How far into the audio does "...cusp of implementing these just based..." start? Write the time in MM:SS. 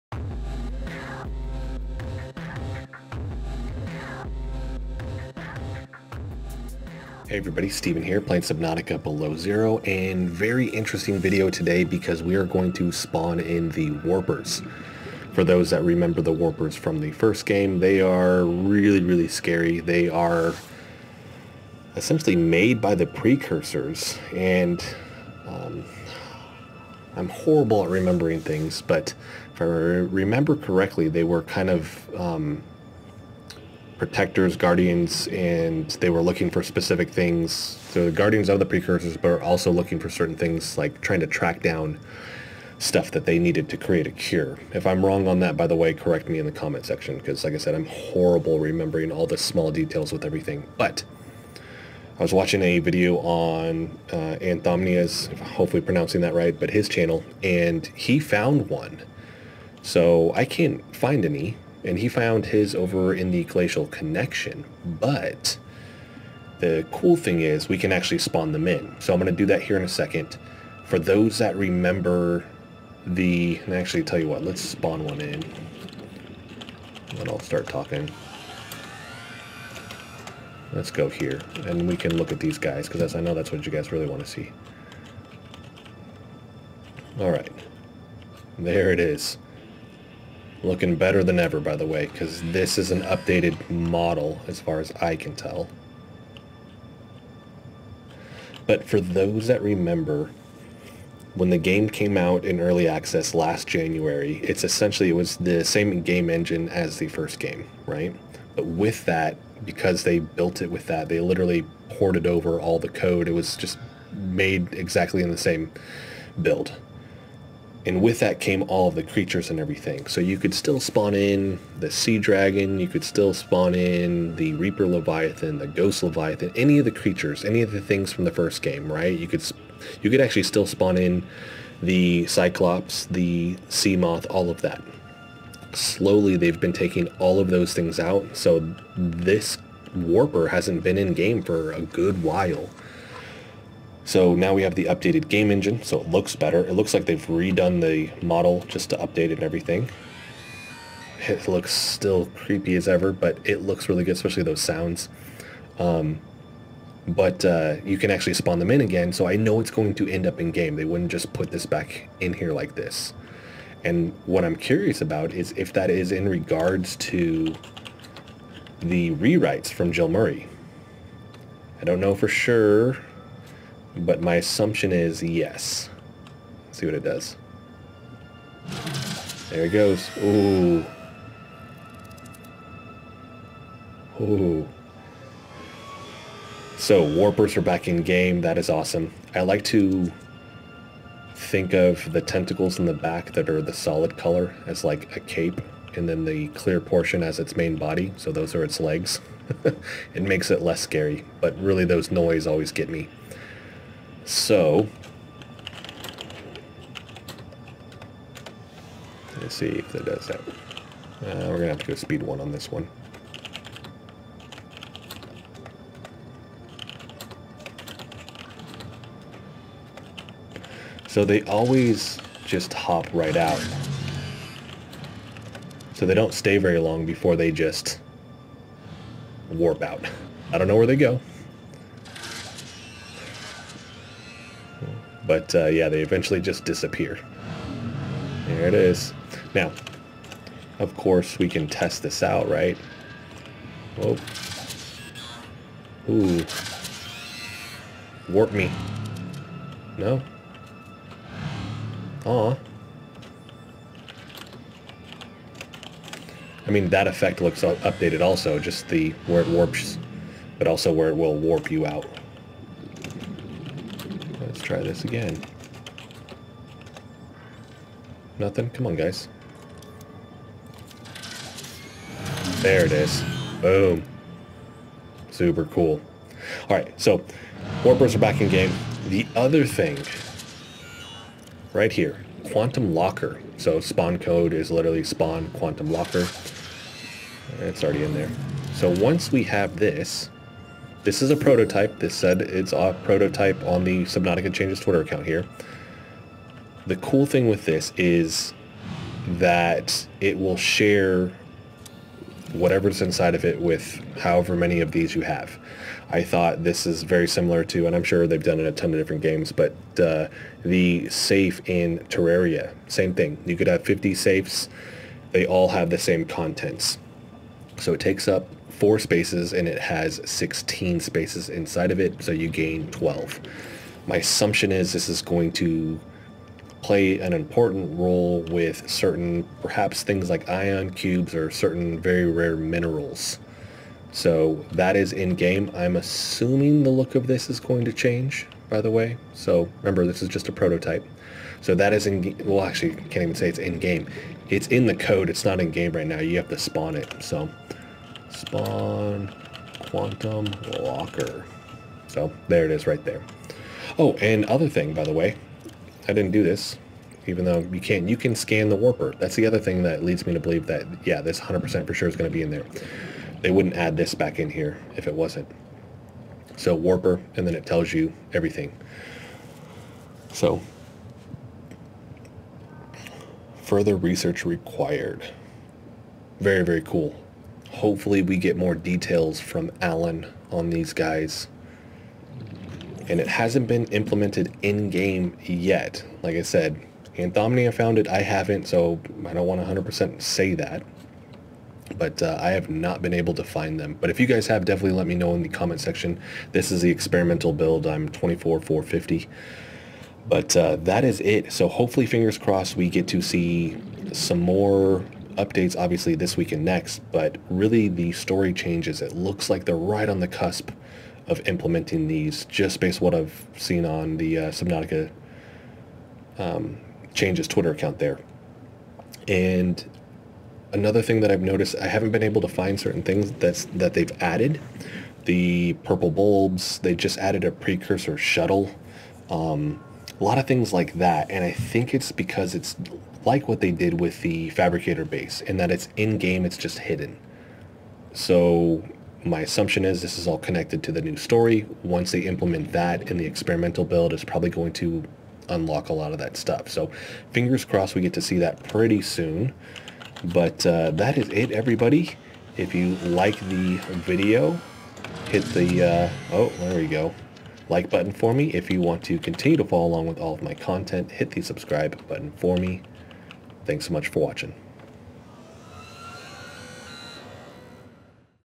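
06:50.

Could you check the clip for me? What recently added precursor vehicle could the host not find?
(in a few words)
Precursor shuttle.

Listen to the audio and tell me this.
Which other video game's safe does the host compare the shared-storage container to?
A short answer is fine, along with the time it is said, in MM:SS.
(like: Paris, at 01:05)
Terraria, at 05:12.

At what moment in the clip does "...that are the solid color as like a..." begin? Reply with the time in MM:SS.
03:13.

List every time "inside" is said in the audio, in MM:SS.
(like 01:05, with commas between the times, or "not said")
05:03, 05:21.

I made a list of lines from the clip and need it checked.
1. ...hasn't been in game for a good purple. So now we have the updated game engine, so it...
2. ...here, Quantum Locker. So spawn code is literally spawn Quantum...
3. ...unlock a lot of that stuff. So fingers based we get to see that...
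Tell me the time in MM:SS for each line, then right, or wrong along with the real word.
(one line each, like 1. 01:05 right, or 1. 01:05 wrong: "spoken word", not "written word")
1. 02:20 wrong: "while", not "purple"
2. 04:41 right
3. 07:25 wrong: "crossed", not "based".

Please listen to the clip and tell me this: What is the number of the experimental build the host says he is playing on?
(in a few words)
24,450.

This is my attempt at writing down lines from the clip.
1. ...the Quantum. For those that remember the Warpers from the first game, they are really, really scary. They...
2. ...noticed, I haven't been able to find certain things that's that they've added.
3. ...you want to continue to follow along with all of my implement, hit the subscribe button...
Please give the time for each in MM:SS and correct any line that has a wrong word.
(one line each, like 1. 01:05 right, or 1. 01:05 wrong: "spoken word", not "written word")
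1. 00:13 wrong: "Warpers", not "Quantum"
2. 07:01 right
3. 07:38 wrong: "content", not "implement".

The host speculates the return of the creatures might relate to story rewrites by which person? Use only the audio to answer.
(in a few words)
Jill Murray.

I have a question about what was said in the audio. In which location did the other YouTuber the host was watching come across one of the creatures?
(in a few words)
Glacial Connection.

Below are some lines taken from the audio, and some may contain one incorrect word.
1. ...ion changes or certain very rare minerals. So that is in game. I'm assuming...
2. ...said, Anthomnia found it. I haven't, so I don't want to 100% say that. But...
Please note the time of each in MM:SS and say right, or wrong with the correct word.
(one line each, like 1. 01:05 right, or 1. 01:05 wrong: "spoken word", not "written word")
1. 05:30 wrong: "cubes", not "changes"
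2. 06:26 right.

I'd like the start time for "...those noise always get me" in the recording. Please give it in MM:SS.
03:21.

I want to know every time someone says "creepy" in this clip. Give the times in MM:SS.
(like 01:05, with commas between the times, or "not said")
02:32.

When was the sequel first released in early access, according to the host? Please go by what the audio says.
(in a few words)
Last January.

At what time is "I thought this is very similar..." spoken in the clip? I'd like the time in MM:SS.
05:06.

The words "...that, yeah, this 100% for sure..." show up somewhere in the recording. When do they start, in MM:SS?
06:00.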